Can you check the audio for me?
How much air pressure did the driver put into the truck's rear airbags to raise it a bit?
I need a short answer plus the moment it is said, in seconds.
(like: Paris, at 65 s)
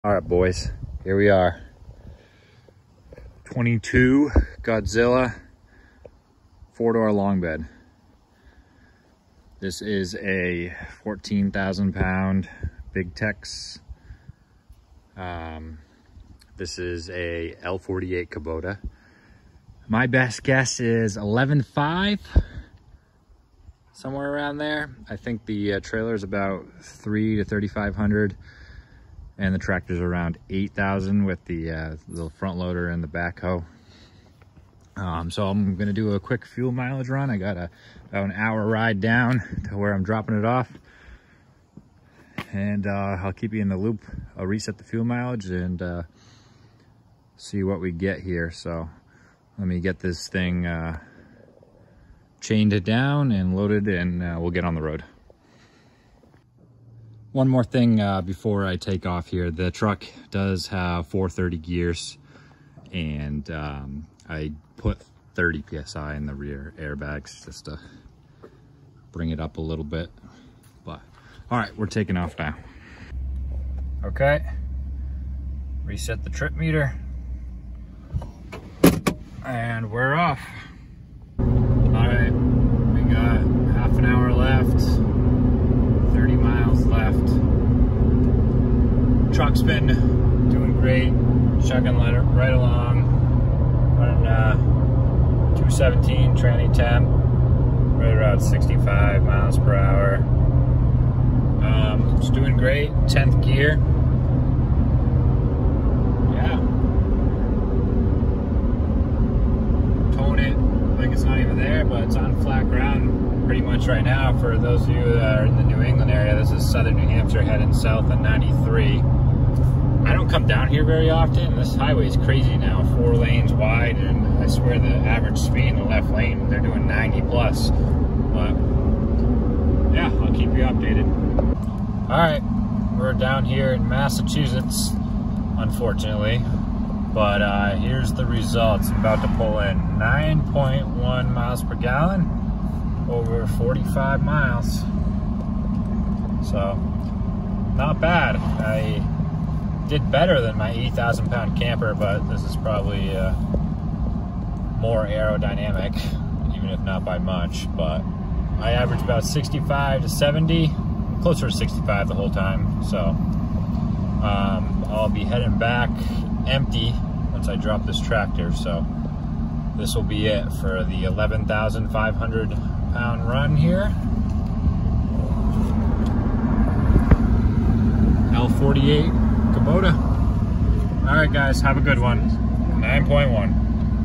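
30 PSI, at 65 s.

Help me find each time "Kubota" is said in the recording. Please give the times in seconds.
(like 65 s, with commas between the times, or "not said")
18 s, 179 s.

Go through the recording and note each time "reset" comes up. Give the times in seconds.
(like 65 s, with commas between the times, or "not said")
44 s, 75 s.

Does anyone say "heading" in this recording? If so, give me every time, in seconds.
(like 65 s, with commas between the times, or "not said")
117 s, 165 s.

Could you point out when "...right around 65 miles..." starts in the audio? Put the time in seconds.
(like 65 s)
97 s.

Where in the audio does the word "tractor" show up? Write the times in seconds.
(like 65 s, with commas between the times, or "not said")
29 s, 167 s.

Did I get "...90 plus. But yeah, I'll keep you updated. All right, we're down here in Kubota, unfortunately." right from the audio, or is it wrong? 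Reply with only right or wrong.
wrong.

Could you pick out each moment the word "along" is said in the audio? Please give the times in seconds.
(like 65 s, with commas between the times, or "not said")
92 s.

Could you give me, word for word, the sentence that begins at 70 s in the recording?
But all right, we're taking off now.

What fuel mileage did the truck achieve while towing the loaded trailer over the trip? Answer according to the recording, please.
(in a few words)
9.1 mpg.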